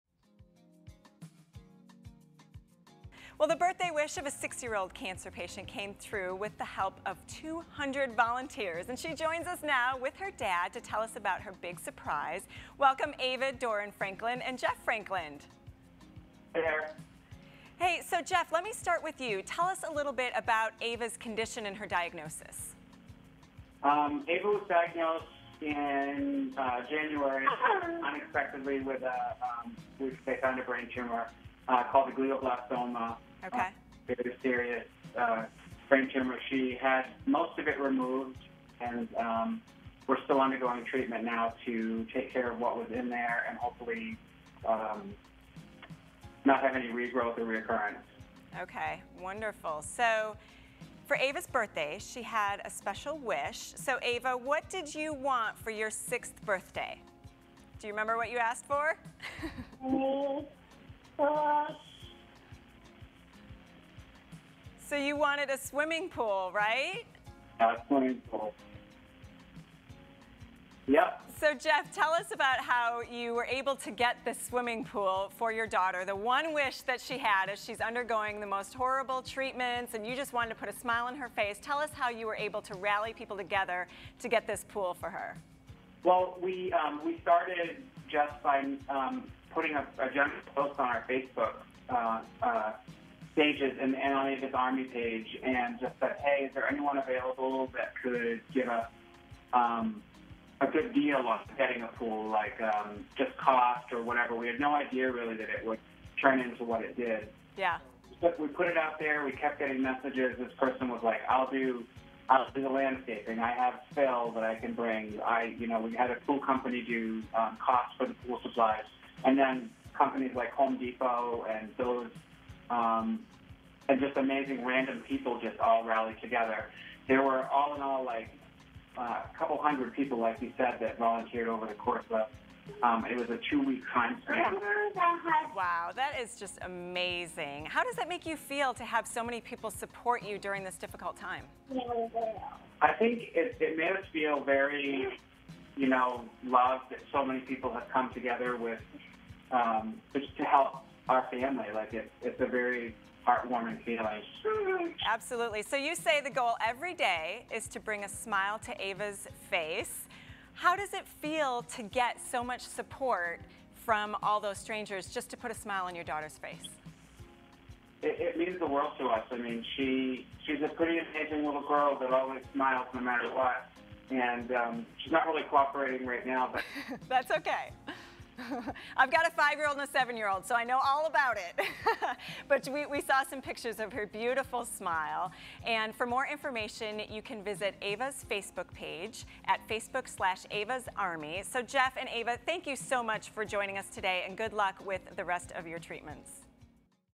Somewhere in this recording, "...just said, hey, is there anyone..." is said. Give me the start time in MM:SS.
01:35.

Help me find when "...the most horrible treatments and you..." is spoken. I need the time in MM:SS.
01:18.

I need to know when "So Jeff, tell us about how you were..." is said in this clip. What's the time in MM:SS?
01:11.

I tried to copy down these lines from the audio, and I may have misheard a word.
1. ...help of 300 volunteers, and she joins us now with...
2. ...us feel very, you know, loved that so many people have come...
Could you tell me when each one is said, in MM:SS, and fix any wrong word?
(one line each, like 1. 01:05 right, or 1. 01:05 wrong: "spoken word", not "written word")
1. 00:06 wrong: "200", not "300"
2. 02:23 right.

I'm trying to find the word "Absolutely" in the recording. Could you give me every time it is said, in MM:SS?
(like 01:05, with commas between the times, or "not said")
02:35.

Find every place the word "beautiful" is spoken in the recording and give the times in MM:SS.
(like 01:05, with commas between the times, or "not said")
03:04.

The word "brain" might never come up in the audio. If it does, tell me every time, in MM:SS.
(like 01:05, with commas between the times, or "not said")
00:30, 00:35.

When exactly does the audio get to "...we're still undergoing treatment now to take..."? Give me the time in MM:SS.
00:40.